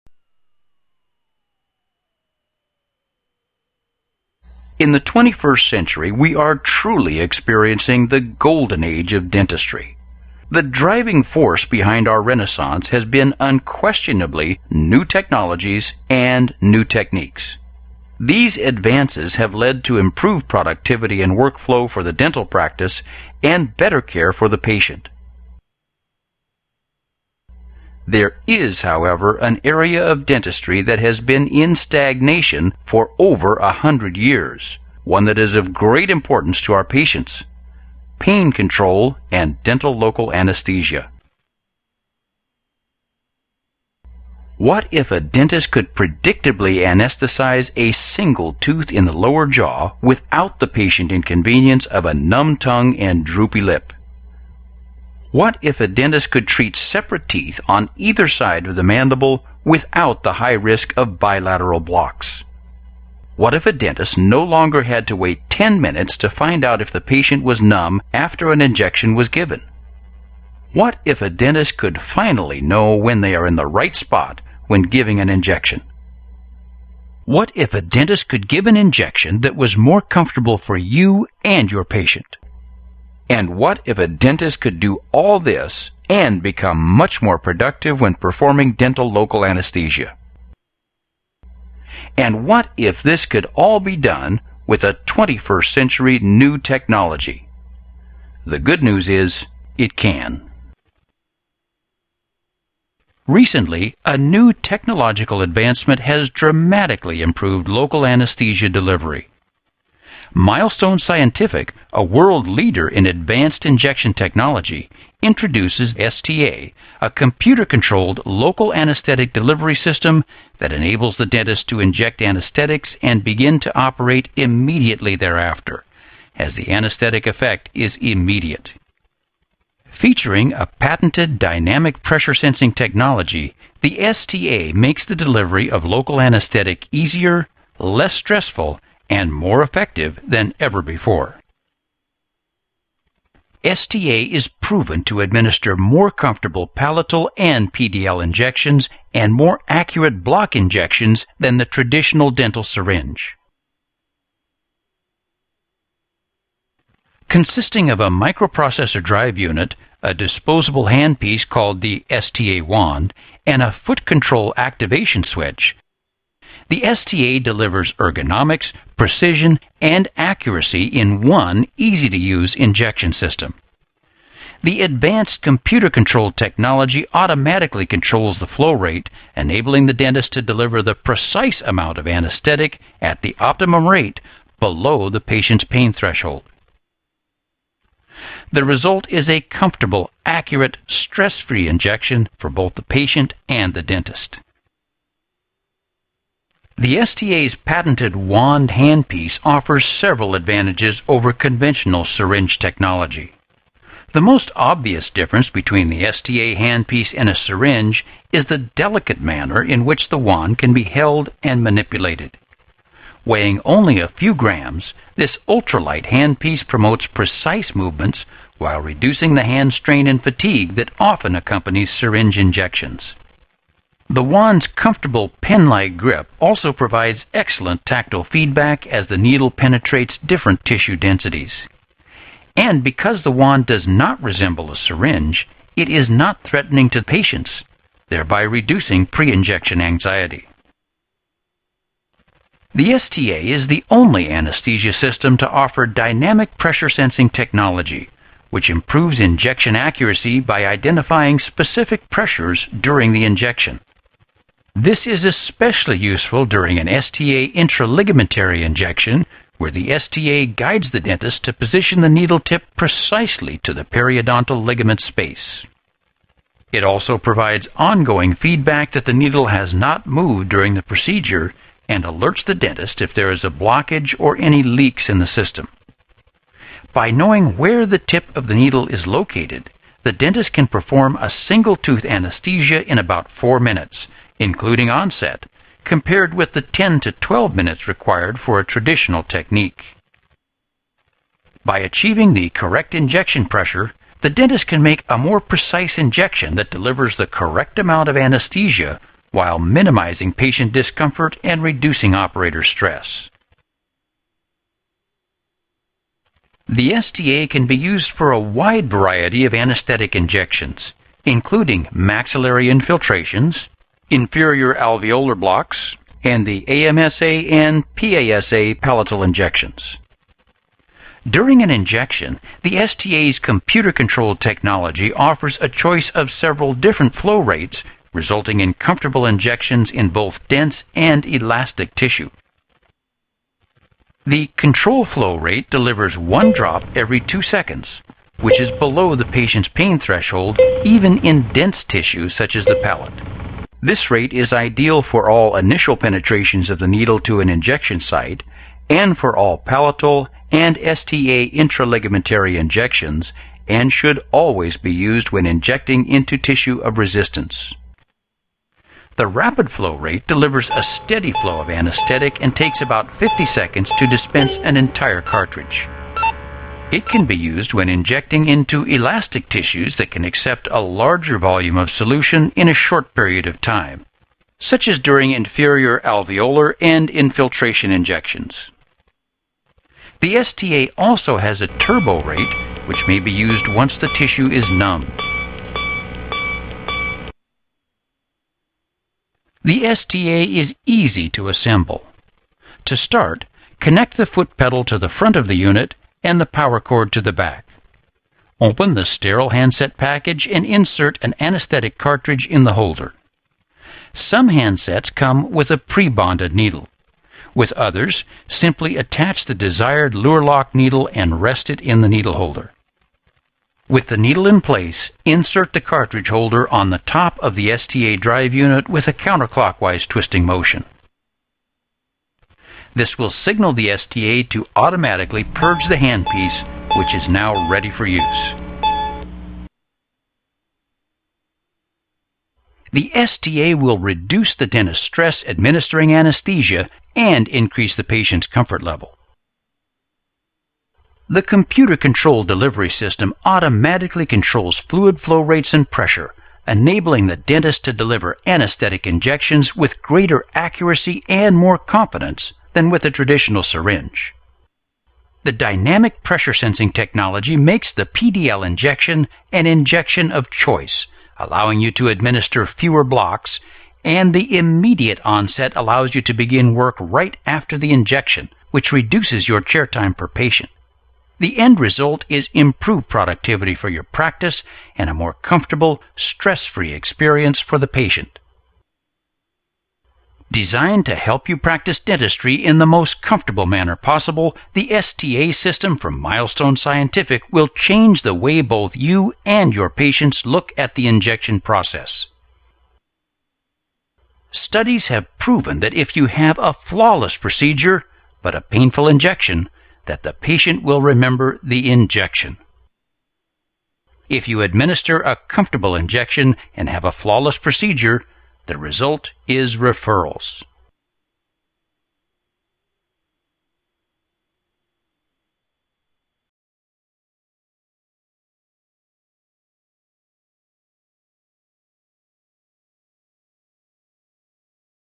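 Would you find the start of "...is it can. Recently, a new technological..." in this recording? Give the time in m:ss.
1:39.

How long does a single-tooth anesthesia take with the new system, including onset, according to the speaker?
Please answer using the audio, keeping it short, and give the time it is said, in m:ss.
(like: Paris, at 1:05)
about 4 minutes, at 4:42.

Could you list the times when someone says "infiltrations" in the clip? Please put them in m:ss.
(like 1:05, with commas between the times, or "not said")
5:12, 6:17.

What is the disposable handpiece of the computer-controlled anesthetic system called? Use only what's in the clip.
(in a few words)
STA wand.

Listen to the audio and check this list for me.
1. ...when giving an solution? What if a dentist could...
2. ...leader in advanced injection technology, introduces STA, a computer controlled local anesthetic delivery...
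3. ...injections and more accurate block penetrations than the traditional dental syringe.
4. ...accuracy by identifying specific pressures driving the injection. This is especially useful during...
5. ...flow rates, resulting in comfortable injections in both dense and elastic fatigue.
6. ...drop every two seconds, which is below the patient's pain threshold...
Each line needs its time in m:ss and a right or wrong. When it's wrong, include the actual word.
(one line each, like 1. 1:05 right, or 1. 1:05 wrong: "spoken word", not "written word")
1. 1:14 wrong: "injection", not "solution"
2. 1:52 right
3. 2:28 wrong: "injections", not "penetrations"
4. 4:09 wrong: "during", not "driving"
5. 5:27 wrong: "tissue", not "fatigue"
6. 5:36 right.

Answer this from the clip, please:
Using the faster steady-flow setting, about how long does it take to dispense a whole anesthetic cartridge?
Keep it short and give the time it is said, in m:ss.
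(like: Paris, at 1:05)
about 50 seconds, at 6:02.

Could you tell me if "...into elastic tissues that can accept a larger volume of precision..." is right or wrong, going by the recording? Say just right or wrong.
wrong.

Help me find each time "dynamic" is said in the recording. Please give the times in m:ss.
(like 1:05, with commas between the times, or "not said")
2:11, 4:05, 7:35.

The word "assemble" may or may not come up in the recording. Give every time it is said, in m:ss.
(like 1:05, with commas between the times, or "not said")
6:31.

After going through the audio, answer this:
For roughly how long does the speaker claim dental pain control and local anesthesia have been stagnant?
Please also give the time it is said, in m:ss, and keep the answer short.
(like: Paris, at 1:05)
over a hundred years, at 0:33.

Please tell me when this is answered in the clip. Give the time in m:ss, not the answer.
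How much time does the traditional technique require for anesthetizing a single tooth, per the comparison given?
4:46.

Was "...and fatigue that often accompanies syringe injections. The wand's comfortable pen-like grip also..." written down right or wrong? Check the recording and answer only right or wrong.
right.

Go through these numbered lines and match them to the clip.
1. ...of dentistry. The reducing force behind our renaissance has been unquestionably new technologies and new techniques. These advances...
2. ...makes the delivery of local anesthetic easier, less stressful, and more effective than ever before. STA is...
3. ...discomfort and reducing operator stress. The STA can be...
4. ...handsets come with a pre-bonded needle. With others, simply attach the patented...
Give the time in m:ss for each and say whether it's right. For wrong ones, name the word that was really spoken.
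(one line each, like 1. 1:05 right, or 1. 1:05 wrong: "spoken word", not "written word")
1. 0:09 wrong: "driving", not "reducing"
2. 2:14 right
3. 5:00 right
4. 6:44 wrong: "desired", not "patented".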